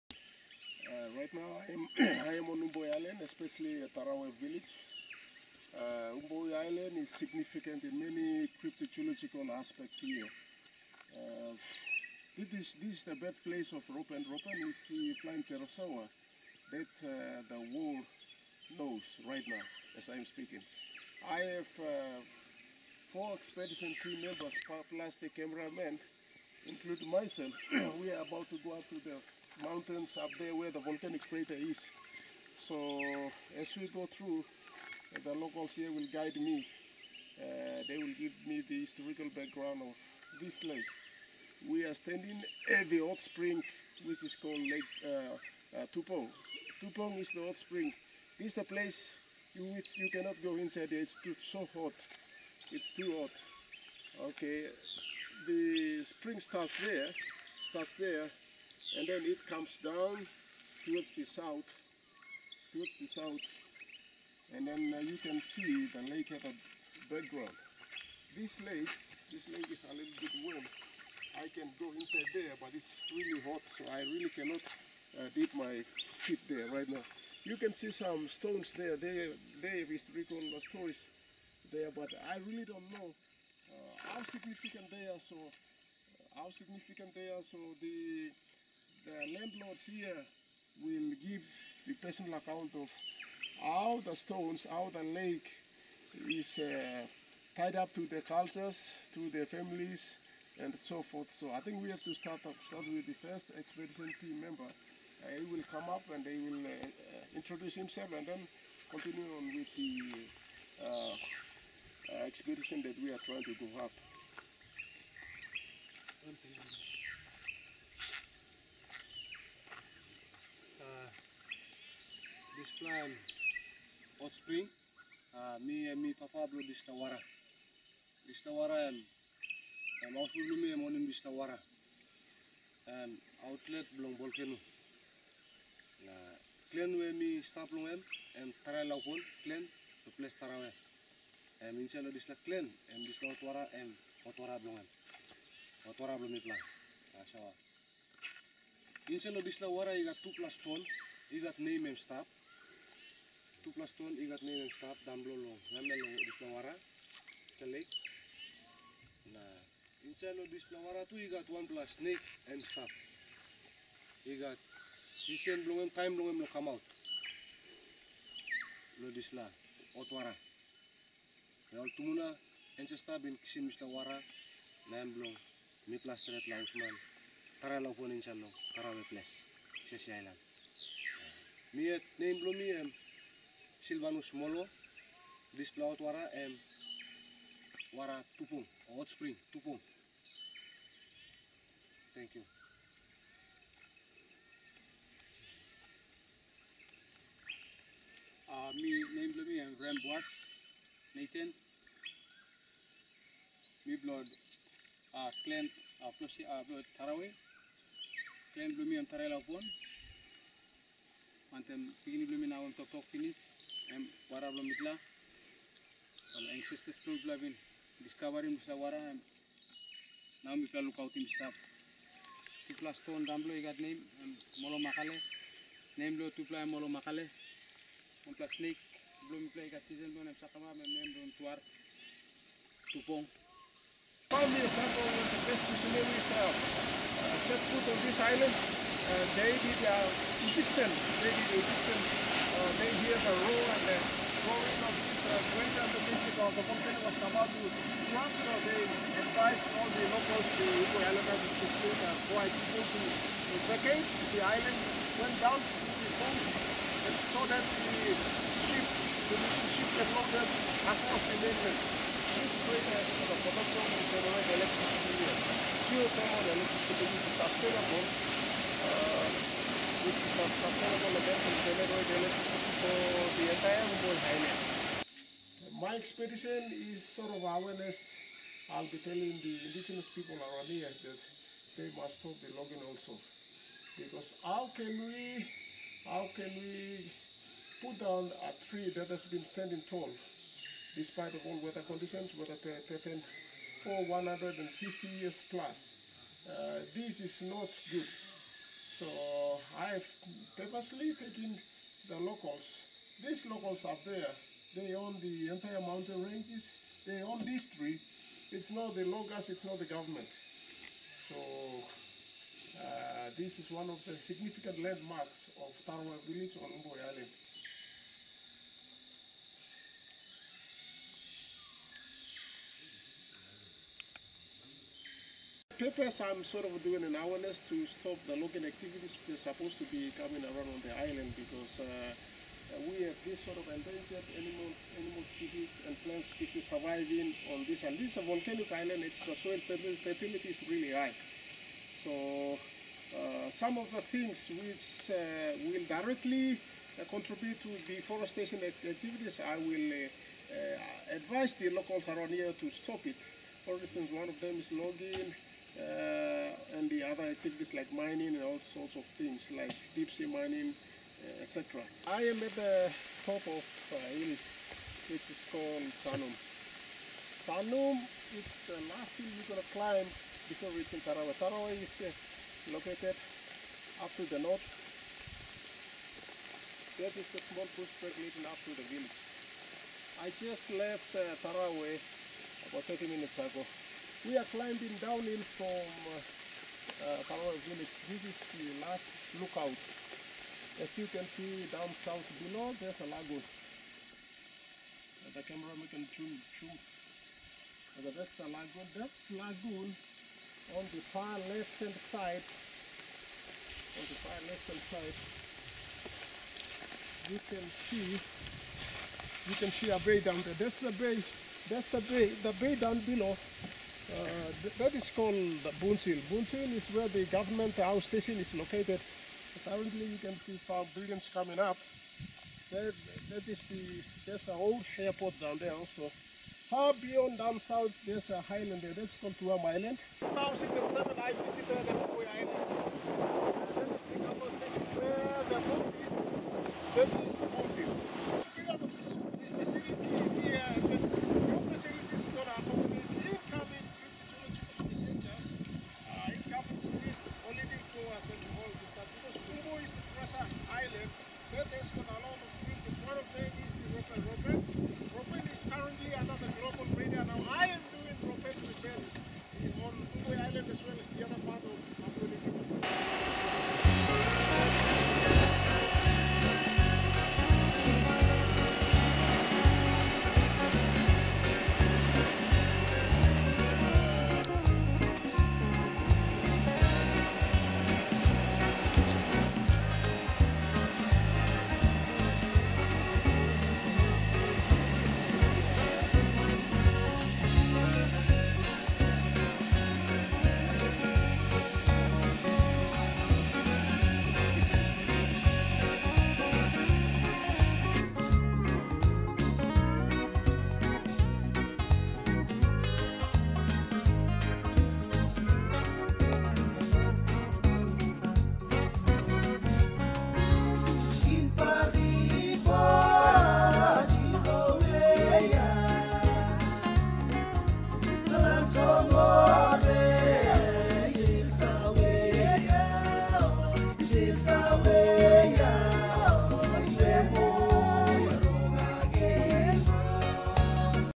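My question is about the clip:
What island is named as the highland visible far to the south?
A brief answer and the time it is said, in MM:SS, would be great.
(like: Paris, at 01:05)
Tuam Island, at 07:09.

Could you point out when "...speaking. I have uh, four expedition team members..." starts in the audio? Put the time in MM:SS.
00:20.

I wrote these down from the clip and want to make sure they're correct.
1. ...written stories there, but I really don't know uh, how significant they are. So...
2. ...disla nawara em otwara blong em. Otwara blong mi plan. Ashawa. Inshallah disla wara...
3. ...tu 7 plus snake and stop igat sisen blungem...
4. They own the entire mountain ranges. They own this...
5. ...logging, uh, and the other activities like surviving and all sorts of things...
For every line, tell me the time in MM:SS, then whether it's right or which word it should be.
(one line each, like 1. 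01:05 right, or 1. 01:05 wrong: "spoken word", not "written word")
1. 01:20 right
2. 02:23 wrong: "otwara", not "nawara"
3. 02:41 wrong: "1", not "7"
4. 05:04 right
5. 05:54 wrong: "mining", not "surviving".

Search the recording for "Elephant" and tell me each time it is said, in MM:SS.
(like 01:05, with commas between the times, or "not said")
04:11.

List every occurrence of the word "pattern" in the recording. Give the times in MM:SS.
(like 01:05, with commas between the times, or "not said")
04:52.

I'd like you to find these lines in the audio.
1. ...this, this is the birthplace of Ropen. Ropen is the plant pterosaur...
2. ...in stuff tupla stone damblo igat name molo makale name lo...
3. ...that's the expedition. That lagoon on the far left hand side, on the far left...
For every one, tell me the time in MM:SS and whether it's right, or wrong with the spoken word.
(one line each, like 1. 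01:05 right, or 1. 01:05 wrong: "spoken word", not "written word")
1. 00:12 right
2. 03:41 right
3. 06:38 wrong: "lagoon", not "expedition".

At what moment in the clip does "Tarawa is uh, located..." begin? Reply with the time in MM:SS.
06:11.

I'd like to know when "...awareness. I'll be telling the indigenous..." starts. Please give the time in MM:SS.
04:37.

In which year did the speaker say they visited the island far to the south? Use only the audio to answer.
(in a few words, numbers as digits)
2007.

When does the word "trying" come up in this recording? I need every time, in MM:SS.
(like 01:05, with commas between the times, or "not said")
01:53.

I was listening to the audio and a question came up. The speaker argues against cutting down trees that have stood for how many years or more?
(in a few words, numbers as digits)
150.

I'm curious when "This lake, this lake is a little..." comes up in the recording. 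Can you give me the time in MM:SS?
01:08.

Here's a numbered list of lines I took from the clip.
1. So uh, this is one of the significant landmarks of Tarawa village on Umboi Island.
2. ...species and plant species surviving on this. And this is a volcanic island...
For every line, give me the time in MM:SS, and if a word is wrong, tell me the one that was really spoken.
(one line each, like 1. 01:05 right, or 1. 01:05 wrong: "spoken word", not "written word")
1. 05:11 right
2. 05:35 right.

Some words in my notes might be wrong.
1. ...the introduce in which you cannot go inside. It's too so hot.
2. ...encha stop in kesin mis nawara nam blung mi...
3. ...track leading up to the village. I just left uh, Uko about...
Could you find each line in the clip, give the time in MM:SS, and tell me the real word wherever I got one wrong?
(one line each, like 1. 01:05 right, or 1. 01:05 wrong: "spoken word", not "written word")
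1. 00:48 wrong: "place", not "introduce"
2. 02:52 right
3. 06:17 wrong: "Tarawa", not "Uko".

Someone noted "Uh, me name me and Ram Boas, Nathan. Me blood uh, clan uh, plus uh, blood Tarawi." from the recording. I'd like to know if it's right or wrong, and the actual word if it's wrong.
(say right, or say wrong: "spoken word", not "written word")
right.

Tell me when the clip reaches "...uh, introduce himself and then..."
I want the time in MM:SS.
01:46.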